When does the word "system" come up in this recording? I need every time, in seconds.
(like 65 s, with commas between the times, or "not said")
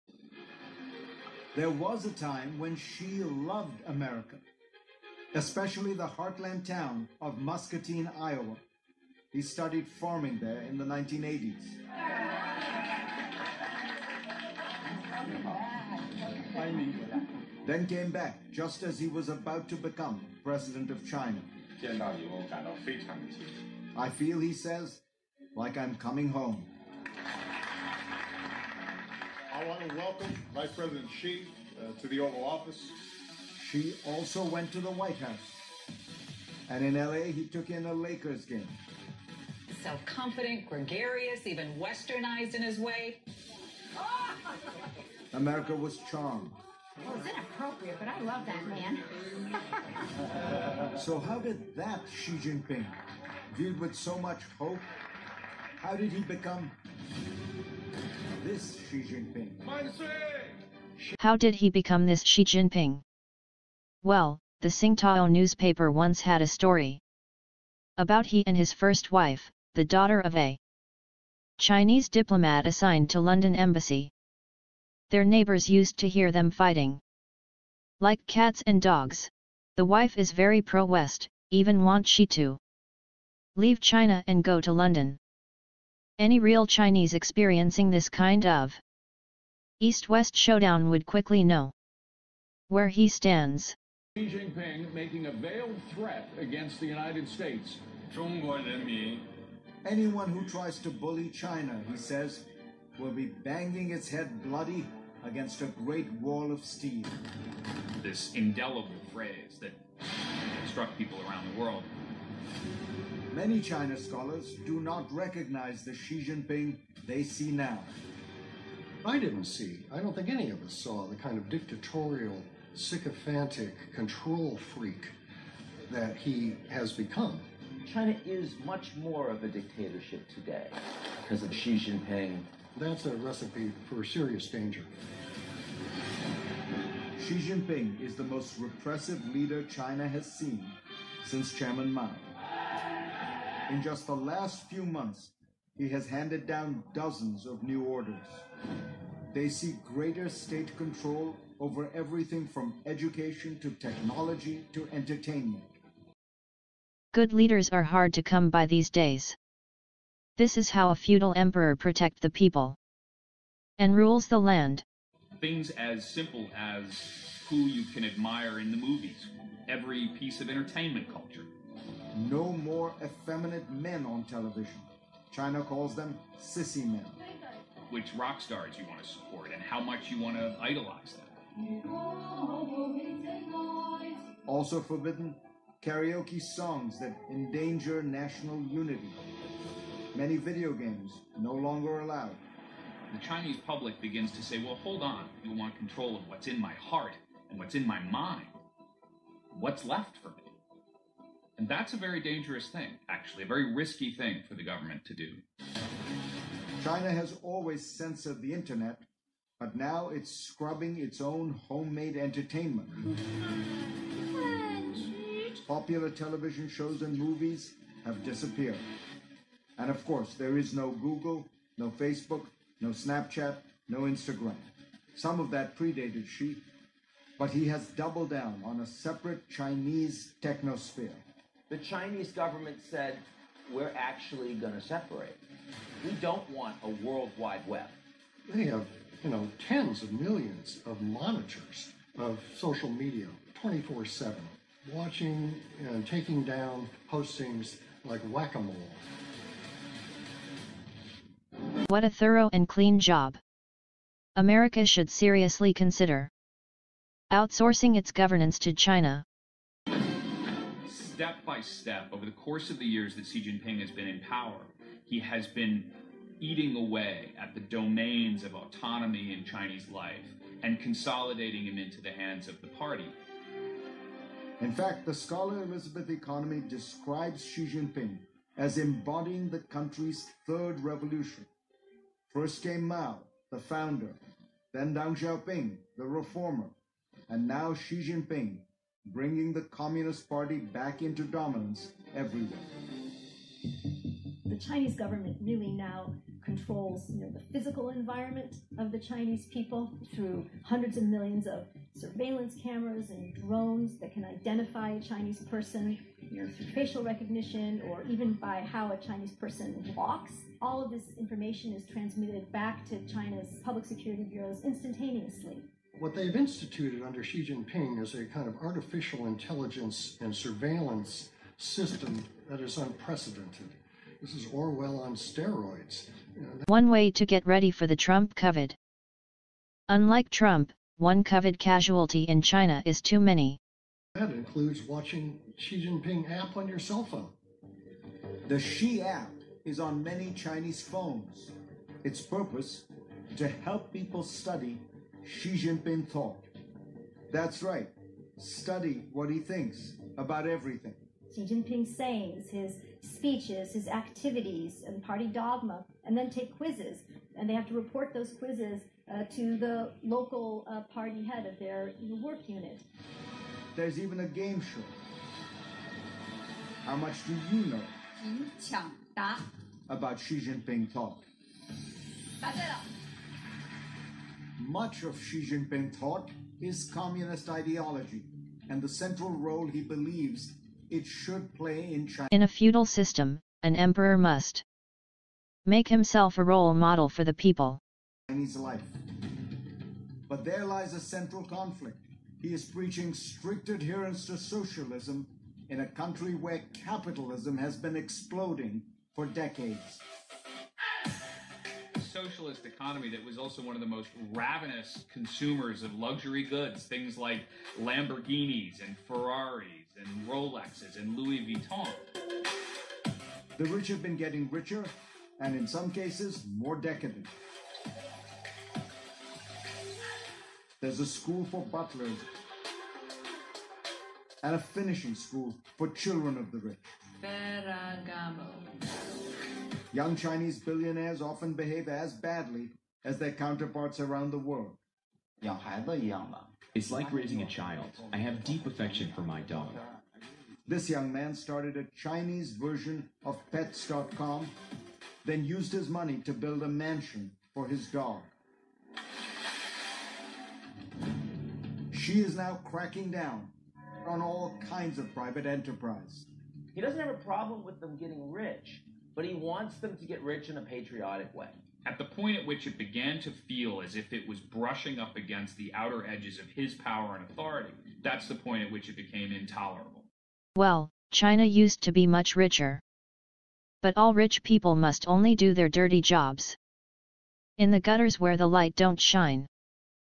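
321 s, 382 s.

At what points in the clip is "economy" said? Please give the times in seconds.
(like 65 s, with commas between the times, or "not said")
276 s, 402 s.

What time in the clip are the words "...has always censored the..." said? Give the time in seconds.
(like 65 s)
207 s.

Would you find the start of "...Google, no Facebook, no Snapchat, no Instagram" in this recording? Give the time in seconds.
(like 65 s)
220 s.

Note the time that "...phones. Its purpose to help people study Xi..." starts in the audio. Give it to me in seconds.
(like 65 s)
340 s.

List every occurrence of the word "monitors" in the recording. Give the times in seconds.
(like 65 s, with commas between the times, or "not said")
241 s.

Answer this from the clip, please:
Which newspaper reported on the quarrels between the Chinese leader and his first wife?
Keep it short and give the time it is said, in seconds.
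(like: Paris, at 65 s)
Singtao, at 64 s.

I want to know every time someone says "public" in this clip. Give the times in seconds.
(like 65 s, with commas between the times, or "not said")
193 s, 313 s.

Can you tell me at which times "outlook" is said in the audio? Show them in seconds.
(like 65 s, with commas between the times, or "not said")
not said.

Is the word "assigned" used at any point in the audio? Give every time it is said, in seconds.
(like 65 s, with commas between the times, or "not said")
72 s.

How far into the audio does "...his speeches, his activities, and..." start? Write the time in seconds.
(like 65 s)
352 s.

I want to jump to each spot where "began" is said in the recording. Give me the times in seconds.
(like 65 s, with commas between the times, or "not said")
462 s.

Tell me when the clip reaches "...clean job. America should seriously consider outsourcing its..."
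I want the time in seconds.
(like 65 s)
252 s.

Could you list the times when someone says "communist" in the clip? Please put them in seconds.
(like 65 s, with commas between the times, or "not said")
289 s, 376 s.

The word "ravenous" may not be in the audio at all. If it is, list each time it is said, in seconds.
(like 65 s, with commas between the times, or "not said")
404 s.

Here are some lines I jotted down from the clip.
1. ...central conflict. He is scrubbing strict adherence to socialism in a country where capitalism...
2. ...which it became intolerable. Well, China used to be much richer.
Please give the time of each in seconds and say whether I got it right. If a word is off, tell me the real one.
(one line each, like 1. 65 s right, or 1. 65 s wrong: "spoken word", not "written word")
1. 390 s wrong: "preaching", not "scrubbing"
2. 468 s right.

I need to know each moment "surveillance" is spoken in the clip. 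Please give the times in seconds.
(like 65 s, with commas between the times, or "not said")
301 s, 320 s.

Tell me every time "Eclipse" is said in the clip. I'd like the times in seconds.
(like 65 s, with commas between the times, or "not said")
not said.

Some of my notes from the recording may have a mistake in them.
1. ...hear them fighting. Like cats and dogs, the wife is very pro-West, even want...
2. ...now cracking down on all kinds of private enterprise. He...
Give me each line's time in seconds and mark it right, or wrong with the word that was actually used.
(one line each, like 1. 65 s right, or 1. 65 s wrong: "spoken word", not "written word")
1. 76 s right
2. 452 s right.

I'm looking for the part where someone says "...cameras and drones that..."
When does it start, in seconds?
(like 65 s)
302 s.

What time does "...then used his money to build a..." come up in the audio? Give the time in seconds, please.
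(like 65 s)
445 s.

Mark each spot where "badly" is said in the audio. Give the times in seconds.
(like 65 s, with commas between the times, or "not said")
432 s.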